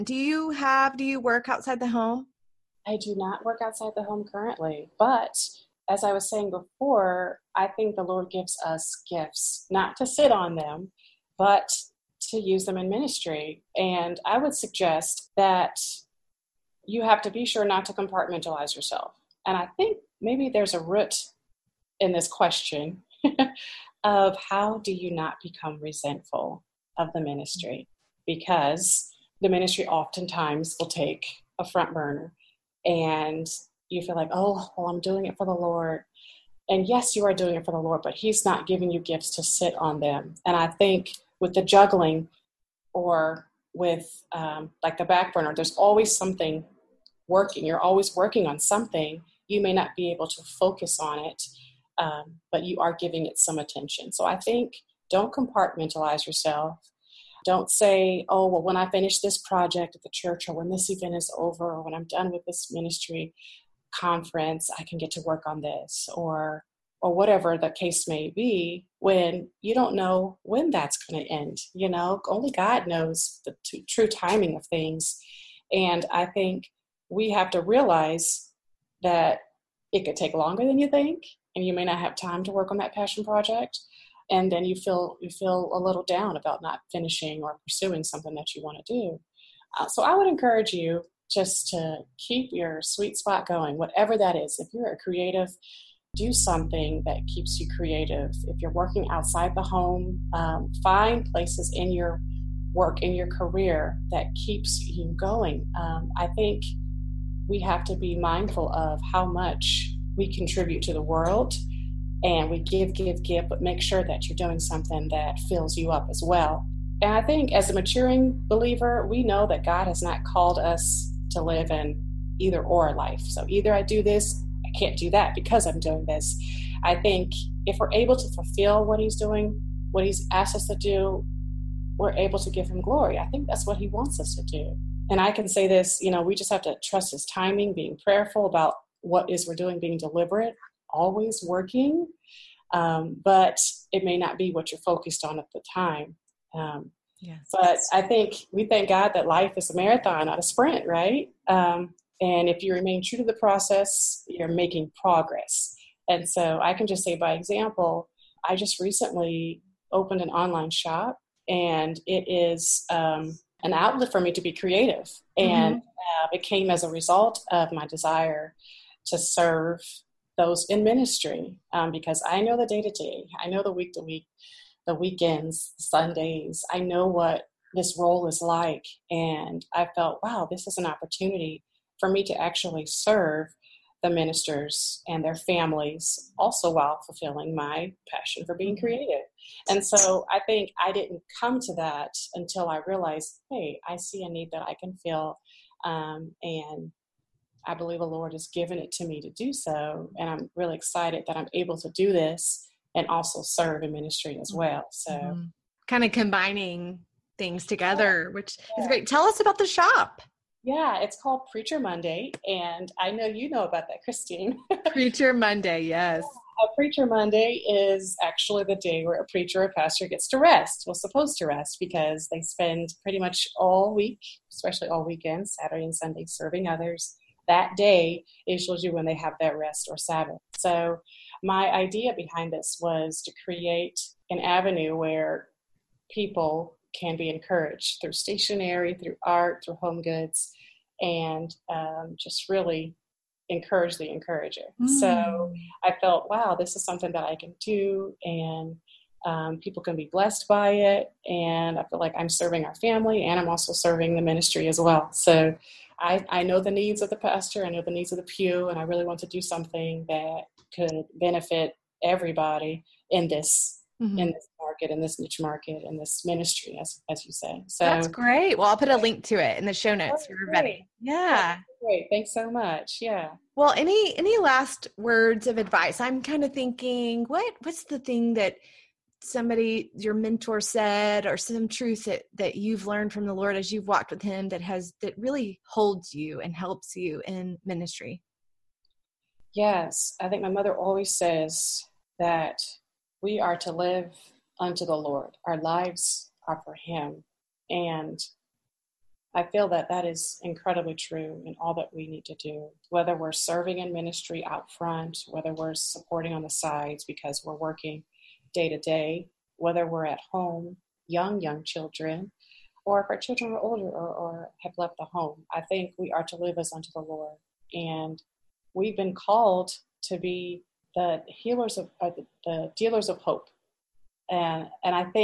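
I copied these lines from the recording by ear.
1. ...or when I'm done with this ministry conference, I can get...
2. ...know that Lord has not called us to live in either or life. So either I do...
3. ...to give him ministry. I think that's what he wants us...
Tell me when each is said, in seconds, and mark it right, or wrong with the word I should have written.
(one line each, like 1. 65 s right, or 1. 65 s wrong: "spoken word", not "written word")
1. 61 s right
2. 119 s wrong: "God", not "Lord"
3. 132 s wrong: "glory", not "ministry".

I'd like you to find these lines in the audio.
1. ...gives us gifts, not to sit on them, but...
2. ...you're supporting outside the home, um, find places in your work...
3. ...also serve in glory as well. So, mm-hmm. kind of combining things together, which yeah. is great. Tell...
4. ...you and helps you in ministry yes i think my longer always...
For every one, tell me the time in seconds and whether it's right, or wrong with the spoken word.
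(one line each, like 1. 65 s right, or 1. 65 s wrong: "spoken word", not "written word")
1. 8 s right
2. 98 s wrong: "working", not "supporting"
3. 203 s wrong: "ministry", not "glory"
4. 286 s wrong: "mother", not "longer".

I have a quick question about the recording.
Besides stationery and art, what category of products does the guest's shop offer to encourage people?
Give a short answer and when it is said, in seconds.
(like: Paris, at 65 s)
Home goods, at 239 s.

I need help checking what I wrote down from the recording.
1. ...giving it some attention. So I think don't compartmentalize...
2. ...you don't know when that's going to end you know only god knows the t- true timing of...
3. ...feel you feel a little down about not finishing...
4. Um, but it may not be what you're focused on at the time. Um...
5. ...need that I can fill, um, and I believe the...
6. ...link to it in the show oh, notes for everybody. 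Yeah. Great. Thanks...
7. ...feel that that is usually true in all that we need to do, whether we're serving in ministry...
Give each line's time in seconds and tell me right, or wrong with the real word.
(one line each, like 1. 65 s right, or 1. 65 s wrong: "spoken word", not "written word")
1. 52 s right
2. 69 s right
3. 84 s right
4. 142 s right
5. 194 s right
6. 268 s right
7. 299 s wrong: "incredibly", not "usually".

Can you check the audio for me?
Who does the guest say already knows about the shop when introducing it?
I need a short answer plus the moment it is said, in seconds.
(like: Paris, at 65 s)
Christine, at 214 s.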